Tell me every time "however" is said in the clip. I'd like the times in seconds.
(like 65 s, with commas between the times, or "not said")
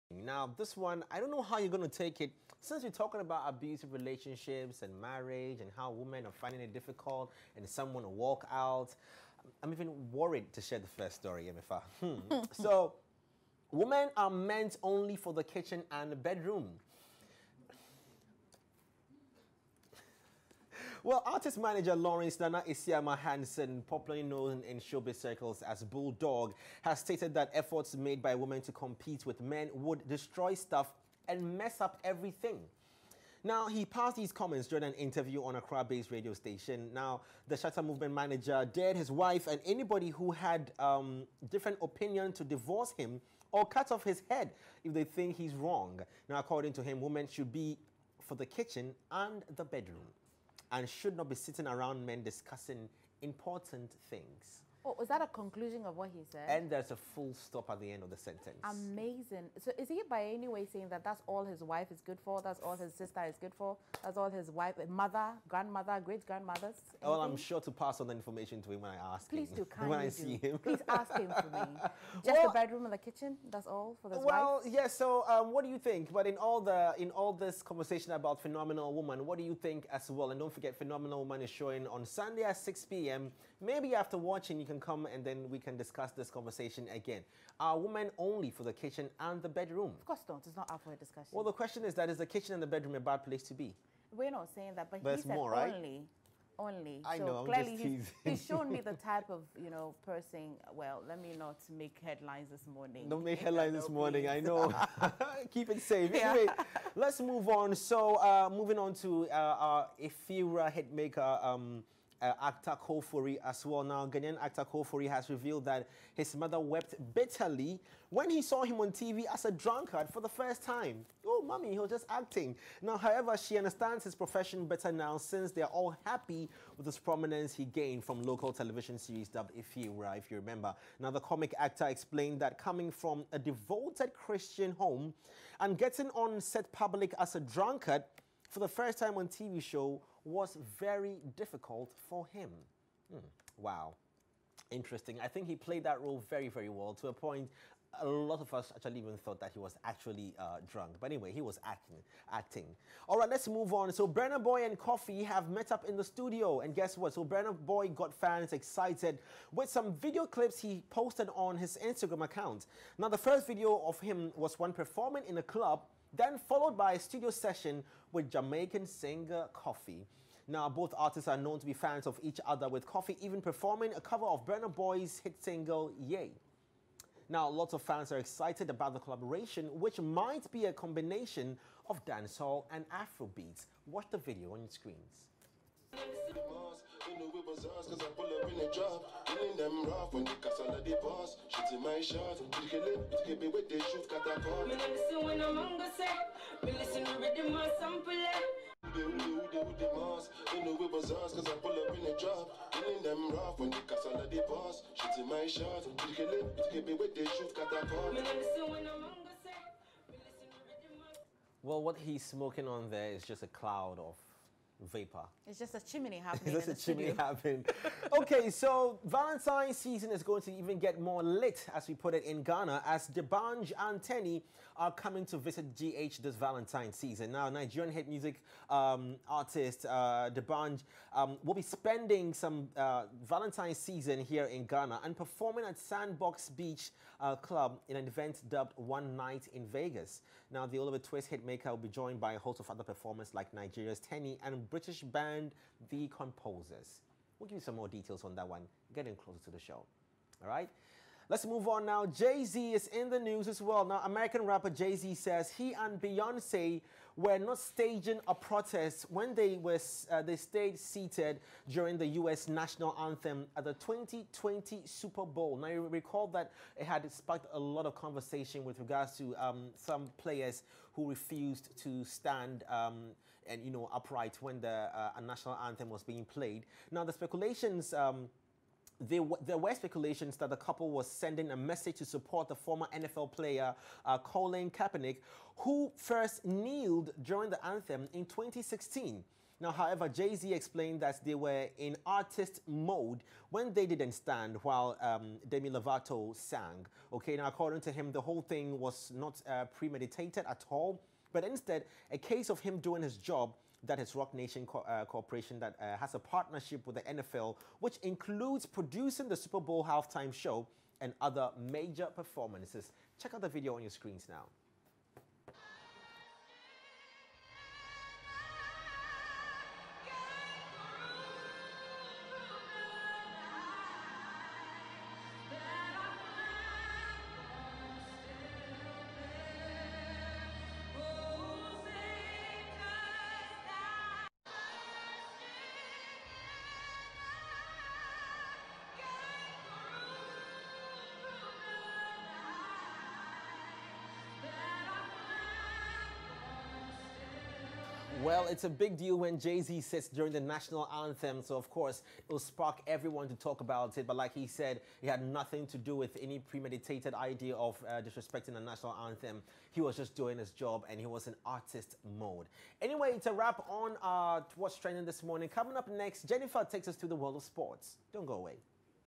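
122 s, 289 s.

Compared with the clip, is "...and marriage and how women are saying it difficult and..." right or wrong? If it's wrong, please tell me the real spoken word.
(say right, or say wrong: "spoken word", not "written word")
wrong: "finding", not "saying".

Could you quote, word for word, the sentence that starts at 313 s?
Check out the video on your screens now.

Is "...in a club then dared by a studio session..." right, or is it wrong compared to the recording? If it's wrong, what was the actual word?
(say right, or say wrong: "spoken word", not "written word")
wrong: "followed", not "dared".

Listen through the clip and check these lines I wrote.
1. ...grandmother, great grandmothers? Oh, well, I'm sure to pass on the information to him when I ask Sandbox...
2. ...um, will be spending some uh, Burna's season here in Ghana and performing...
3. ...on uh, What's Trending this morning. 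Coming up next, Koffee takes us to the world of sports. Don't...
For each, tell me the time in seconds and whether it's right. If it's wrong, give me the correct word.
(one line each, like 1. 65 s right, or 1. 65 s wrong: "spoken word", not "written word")
1. 65 s wrong: "Please", not "Sandbox"
2. 231 s wrong: "Valentine", not "Burna"
3. 363 s wrong: "Jennifer", not "Koffee".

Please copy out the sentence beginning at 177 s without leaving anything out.
Now, lots of fans are excited about the collaboration, which might be a combination of dancehall and Afrobeats.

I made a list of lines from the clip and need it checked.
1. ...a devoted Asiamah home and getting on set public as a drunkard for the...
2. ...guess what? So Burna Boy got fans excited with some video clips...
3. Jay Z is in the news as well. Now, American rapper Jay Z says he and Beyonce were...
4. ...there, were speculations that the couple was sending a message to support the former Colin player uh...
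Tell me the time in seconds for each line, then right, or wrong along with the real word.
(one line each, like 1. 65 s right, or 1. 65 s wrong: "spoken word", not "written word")
1. 133 s wrong: "Christian", not "Asiamah"
2. 156 s right
3. 252 s right
4. 279 s wrong: "NFL", not "Colin".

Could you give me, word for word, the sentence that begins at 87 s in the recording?
Are women only for the kitchen and the bedroom?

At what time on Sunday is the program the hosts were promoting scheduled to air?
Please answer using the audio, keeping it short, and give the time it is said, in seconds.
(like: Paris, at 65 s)
6 p.m., at 82 s.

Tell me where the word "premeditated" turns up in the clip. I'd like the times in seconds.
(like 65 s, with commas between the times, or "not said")
299 s, 356 s.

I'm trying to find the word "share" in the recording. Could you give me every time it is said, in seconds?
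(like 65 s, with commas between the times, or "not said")
10 s.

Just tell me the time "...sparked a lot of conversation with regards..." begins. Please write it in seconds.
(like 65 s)
267 s.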